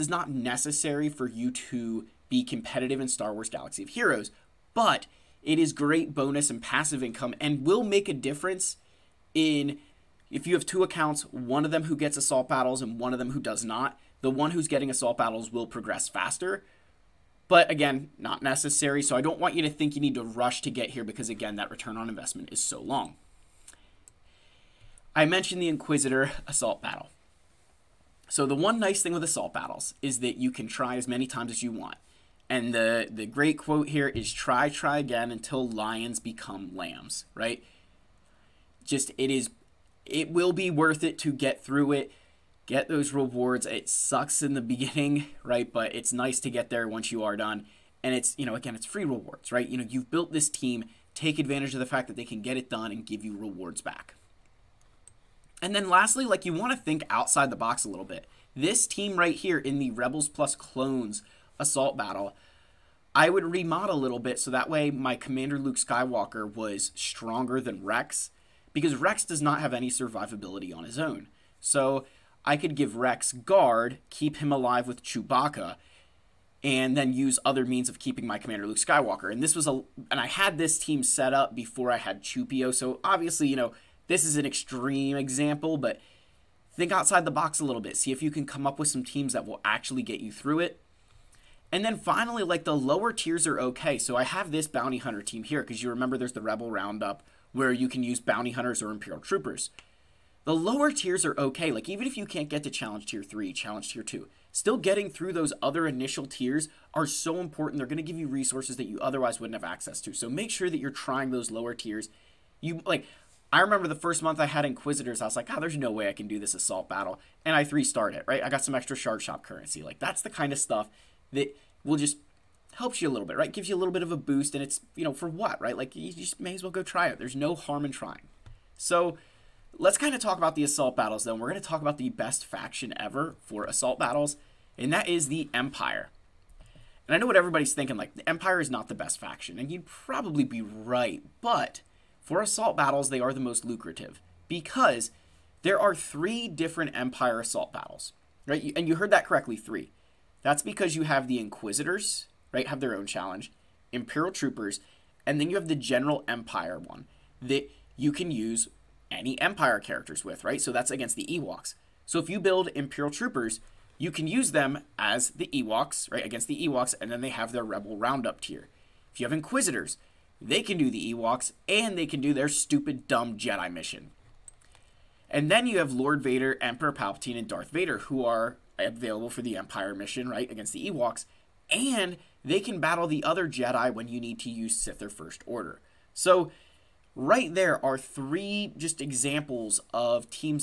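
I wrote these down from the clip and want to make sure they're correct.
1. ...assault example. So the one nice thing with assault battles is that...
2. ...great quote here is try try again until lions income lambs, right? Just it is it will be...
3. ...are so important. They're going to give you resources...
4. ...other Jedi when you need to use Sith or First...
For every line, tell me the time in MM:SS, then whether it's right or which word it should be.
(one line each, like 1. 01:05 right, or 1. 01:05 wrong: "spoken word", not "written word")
1. 00:26 wrong: "battle", not "example"
2. 00:33 wrong: "become", not "income"
3. 01:46 right
4. 03:03 right.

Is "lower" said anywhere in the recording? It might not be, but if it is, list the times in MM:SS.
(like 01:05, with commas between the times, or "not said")
01:32, 01:40, 01:51.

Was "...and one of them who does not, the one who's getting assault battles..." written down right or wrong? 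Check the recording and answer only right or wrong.
right.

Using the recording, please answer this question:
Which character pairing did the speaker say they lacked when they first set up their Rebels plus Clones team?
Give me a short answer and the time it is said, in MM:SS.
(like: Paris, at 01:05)
Chewpio, at 01:22.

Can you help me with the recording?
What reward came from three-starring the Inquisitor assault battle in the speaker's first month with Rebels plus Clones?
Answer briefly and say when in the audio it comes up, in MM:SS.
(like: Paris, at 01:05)
shard shop currency, at 01:58.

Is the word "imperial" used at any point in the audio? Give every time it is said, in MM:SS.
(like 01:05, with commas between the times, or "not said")
01:38, 02:33, 02:42.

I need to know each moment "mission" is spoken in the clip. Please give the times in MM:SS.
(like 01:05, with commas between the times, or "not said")
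02:53, 02:59.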